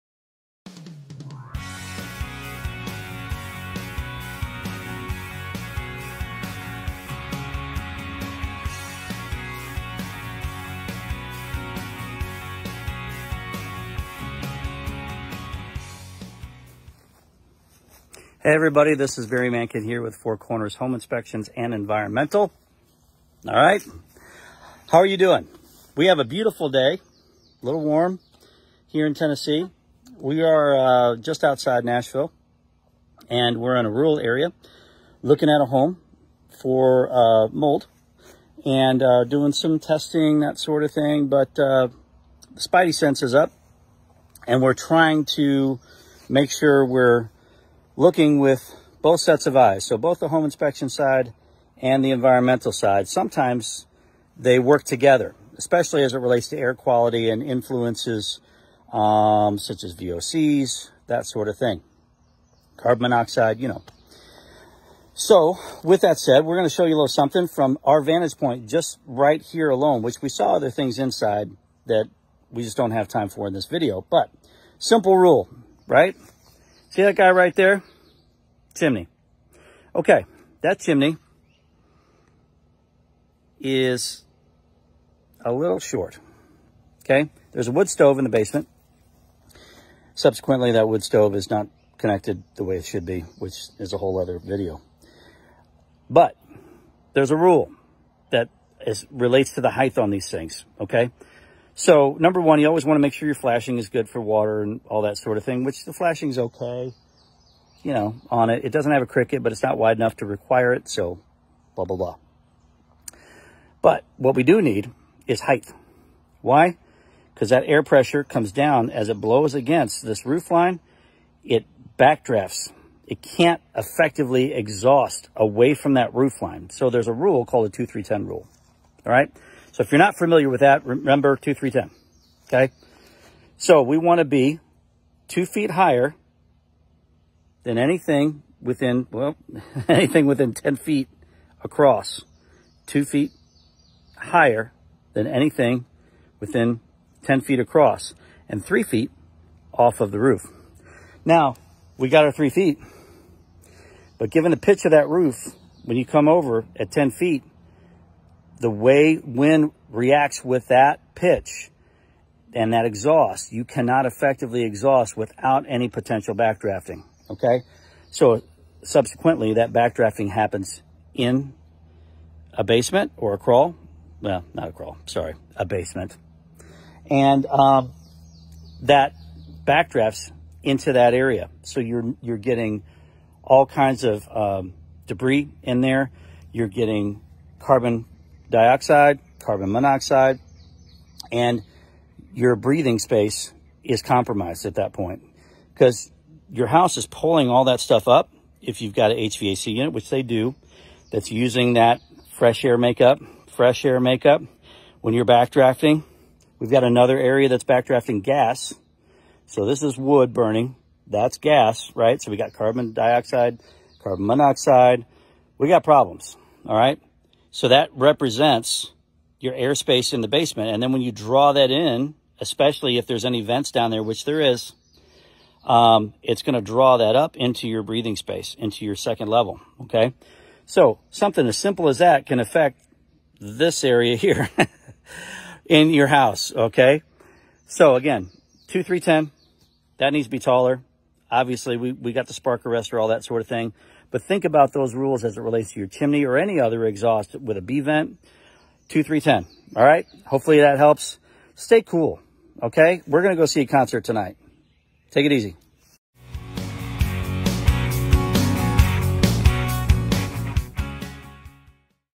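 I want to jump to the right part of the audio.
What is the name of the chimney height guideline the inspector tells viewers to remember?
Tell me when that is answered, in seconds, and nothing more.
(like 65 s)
127 s.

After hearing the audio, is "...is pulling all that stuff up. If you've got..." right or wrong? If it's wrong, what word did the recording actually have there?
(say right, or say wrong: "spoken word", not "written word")
right.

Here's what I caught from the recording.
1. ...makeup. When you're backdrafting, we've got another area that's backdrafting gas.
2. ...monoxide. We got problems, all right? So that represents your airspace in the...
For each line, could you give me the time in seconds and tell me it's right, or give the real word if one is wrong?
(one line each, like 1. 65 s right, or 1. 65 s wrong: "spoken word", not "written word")
1. 203 s right
2. 214 s right.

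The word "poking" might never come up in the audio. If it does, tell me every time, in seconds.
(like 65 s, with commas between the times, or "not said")
not said.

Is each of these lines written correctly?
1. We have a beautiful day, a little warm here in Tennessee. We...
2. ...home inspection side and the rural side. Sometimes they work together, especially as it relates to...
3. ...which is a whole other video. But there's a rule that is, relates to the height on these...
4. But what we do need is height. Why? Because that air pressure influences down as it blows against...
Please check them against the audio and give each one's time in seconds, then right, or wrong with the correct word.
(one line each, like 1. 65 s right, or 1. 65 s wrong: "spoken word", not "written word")
1. 25 s right
2. 50 s wrong: "environmental", not "rural"
3. 93 s right
4. 113 s wrong: "comes", not "influences".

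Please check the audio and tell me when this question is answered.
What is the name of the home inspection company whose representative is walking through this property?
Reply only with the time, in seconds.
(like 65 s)
20 s.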